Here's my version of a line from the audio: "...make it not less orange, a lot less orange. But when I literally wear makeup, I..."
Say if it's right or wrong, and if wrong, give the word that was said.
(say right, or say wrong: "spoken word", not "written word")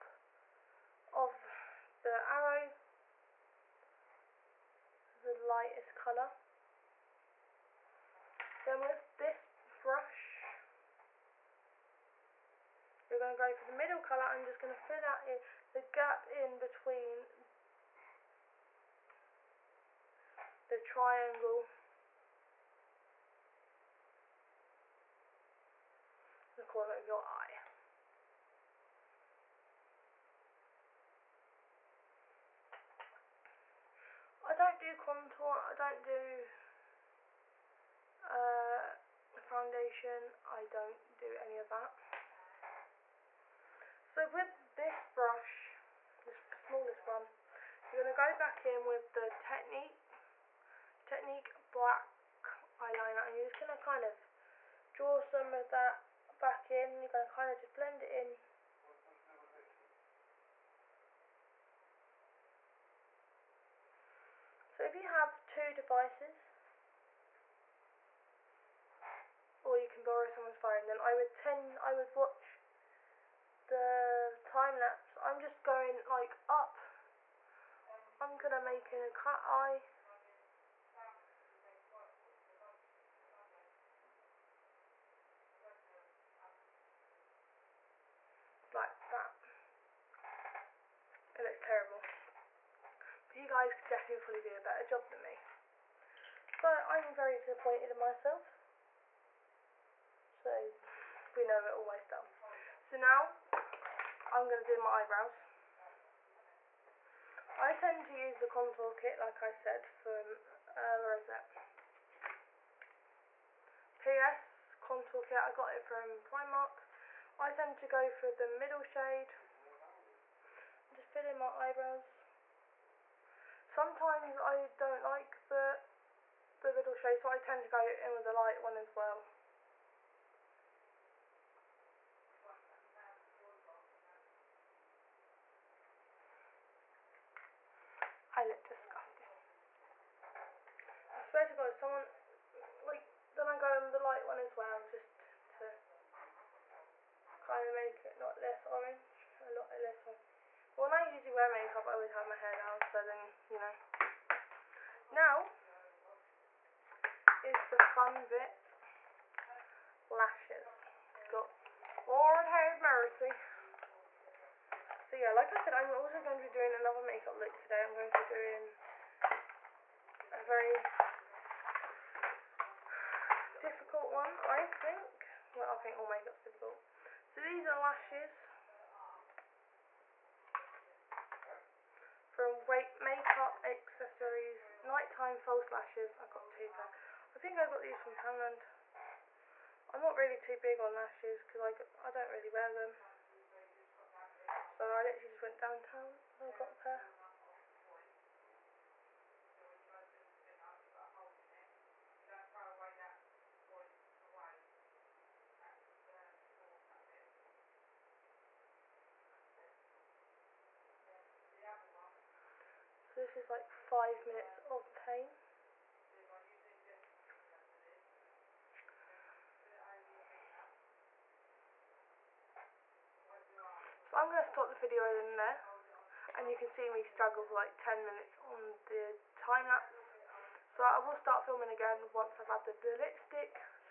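wrong: "usually", not "literally".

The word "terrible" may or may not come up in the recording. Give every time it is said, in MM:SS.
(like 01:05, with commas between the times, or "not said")
01:31.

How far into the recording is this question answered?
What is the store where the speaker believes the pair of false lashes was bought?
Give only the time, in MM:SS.
03:08.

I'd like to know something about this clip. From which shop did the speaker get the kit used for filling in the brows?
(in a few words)
Primark.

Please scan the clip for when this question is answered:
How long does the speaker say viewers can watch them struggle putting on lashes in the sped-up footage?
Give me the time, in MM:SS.
03:47.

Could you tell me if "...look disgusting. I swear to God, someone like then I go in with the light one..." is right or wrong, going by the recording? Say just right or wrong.
right.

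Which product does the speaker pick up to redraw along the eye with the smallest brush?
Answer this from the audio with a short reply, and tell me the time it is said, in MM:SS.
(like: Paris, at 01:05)
Technique Black Eyeliner, at 00:51.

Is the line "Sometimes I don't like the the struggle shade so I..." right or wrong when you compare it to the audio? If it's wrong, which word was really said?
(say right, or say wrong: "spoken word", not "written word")
wrong: "middle", not "struggle".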